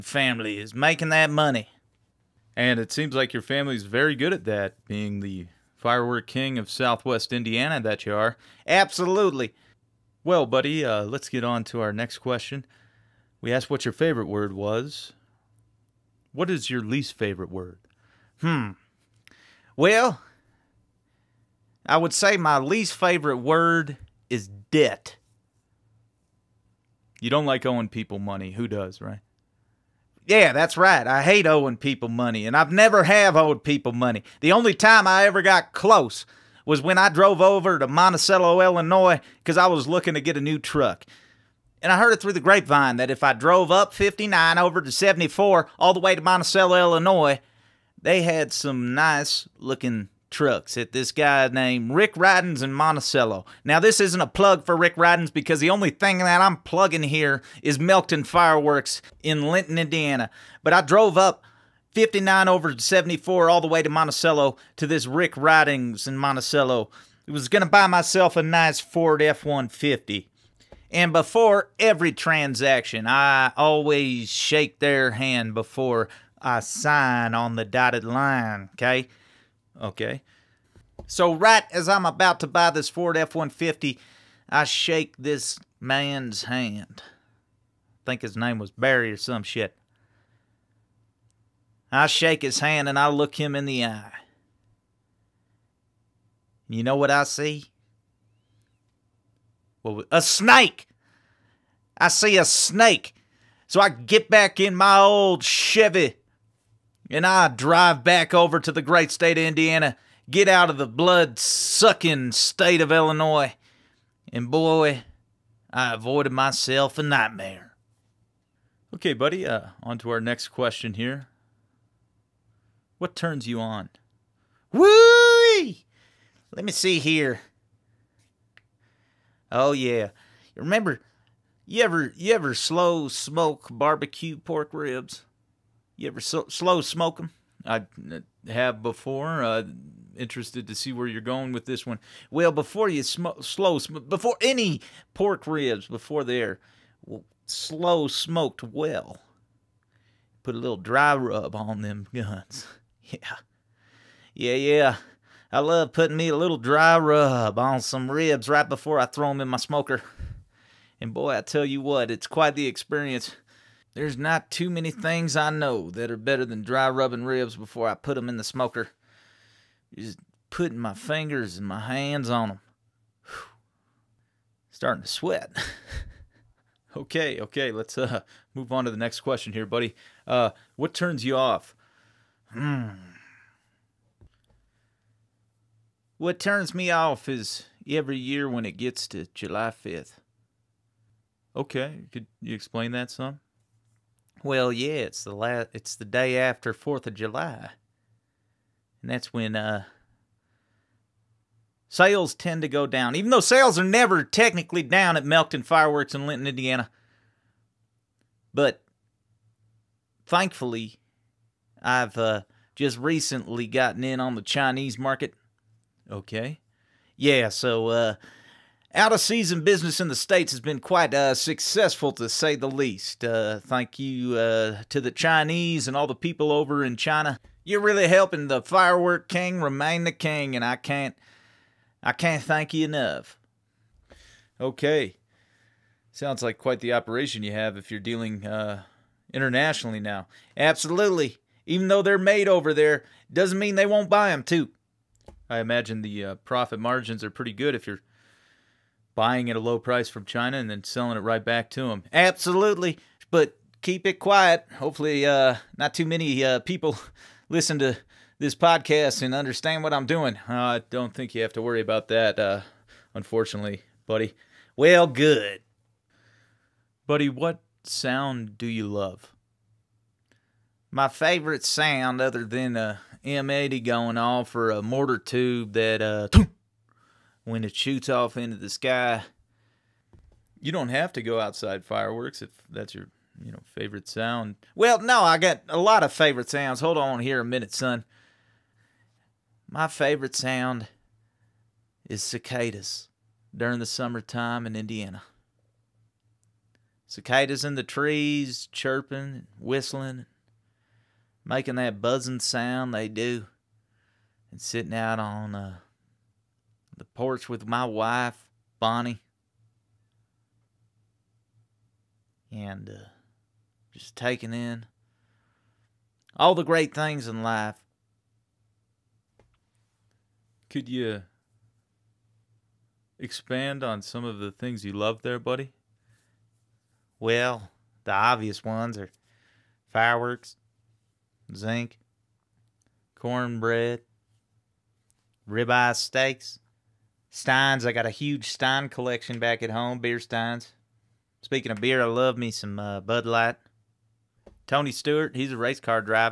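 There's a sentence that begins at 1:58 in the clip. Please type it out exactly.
Okay, buddy, uh, on to our next question here.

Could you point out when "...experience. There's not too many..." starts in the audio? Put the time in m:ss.
2:42.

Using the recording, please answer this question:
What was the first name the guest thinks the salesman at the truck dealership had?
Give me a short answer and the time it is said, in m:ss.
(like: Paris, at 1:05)
Barry, at 1:28.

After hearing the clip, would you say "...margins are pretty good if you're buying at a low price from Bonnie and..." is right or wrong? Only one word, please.
wrong.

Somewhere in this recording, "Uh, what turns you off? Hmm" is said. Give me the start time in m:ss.
3:00.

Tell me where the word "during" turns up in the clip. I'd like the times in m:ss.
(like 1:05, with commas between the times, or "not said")
4:53.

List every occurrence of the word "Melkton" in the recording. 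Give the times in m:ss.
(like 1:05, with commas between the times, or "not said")
0:57, 3:25.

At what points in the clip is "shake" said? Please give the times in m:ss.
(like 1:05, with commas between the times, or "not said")
1:14, 1:24, 1:32.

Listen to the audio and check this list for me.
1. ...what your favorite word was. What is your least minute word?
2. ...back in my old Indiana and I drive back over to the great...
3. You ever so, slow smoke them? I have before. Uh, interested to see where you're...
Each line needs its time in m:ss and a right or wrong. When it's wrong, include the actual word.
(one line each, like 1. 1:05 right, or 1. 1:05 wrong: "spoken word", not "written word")
1. 0:13 wrong: "favorite", not "minute"
2. 1:44 wrong: "Chevy", not "Indiana"
3. 2:15 right.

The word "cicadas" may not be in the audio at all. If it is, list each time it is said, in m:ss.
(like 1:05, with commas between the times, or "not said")
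4:52, 4:57.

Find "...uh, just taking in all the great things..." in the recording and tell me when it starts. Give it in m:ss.
5:12.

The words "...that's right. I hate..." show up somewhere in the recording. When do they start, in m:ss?
0:30.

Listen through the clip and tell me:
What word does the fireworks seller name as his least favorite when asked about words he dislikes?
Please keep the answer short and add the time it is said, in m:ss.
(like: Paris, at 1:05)
Debt, at 0:24.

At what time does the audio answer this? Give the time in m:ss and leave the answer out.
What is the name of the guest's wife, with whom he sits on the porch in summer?
5:08.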